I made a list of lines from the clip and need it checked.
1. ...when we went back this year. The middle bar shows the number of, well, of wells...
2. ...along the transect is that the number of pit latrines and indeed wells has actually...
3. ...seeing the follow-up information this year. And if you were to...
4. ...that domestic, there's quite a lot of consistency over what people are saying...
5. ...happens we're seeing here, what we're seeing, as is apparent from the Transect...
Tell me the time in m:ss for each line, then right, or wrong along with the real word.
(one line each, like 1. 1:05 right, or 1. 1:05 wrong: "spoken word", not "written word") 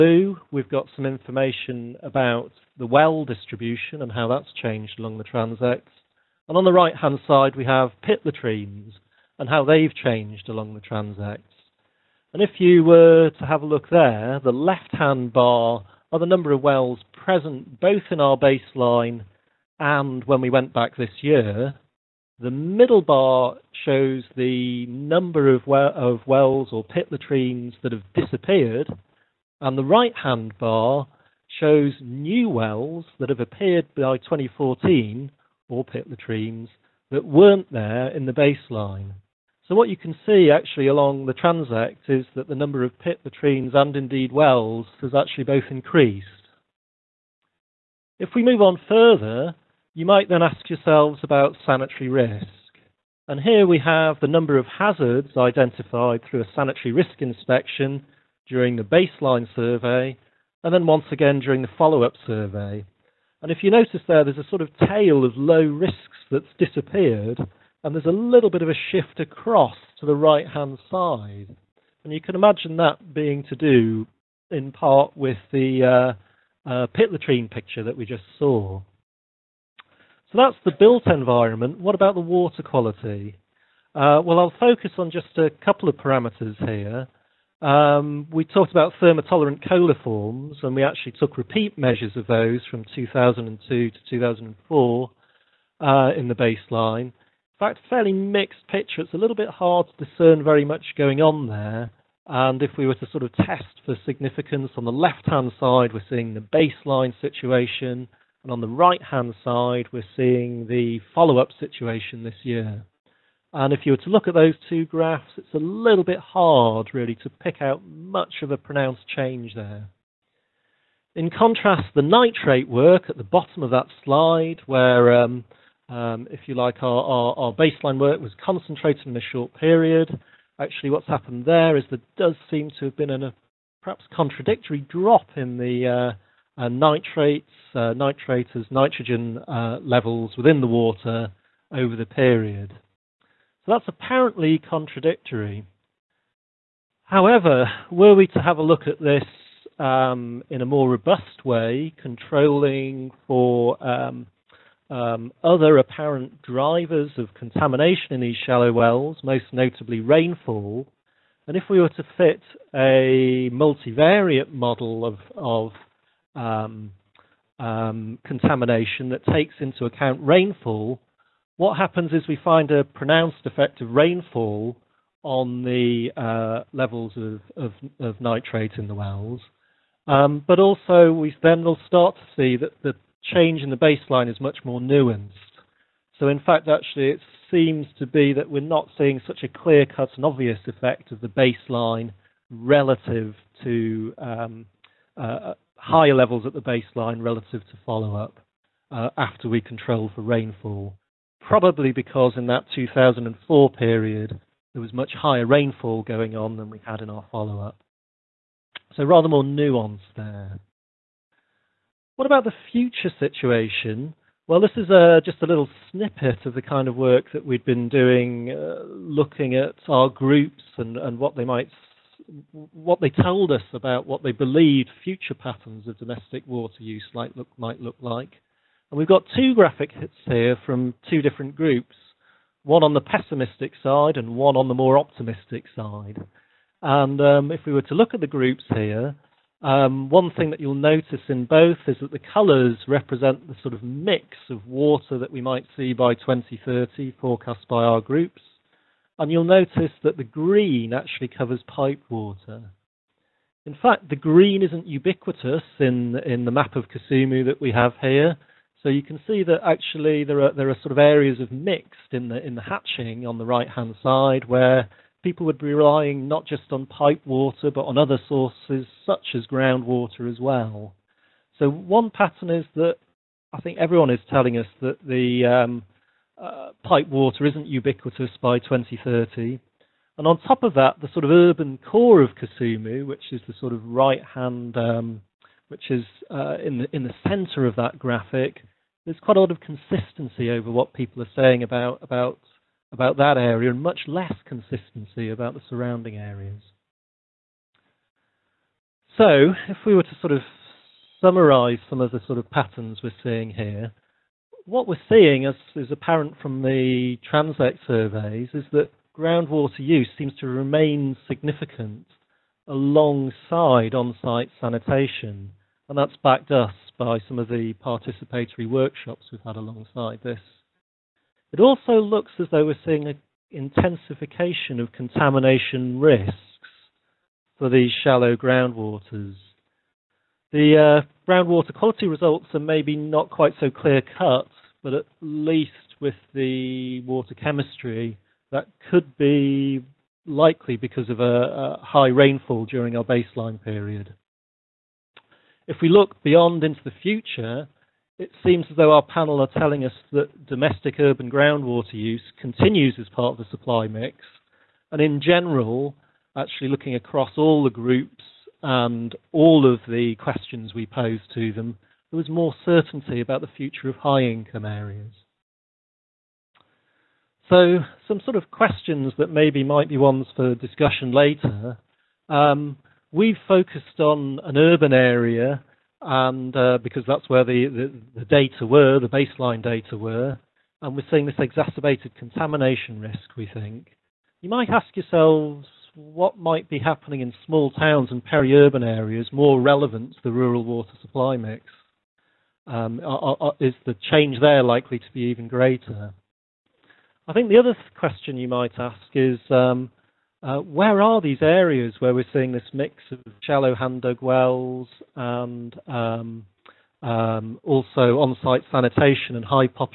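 1. 0:20 right
2. 0:40 right
3. 1:50 wrong: "situation", not "information"
4. 4:47 wrong: "graphic", not "domestic"
5. 5:02 wrong: "patterns", not "happens".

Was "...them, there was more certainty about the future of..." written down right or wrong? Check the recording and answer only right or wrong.
right.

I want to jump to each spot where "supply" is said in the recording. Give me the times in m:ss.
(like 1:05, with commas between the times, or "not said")
5:53, 6:30.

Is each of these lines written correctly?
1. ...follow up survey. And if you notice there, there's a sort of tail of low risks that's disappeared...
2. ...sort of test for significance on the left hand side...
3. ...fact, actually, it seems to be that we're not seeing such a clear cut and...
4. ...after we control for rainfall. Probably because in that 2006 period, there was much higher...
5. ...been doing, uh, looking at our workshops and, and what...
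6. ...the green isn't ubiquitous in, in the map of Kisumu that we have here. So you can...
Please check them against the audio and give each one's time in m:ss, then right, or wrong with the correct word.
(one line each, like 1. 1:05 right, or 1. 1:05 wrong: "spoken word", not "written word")
1. 1:01 right
2. 1:43 right
3. 3:06 right
4. 3:19 wrong: "2004", not "2006"
5. 3:37 wrong: "groups", not "workshops"
6. 4:14 right.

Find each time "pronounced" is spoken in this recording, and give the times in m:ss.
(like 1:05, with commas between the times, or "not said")
1:58, 2:52.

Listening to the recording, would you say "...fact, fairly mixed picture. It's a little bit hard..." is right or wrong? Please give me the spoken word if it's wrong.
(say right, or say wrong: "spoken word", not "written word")
right.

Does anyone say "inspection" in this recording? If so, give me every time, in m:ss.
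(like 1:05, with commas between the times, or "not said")
0:57.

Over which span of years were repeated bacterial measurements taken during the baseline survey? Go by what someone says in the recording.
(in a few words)
2002 to 2004.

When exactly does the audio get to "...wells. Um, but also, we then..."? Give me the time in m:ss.
2:58.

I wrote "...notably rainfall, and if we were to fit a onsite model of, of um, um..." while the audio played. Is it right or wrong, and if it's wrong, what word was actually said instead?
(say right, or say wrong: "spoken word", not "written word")
wrong: "multivariate", not "onsite".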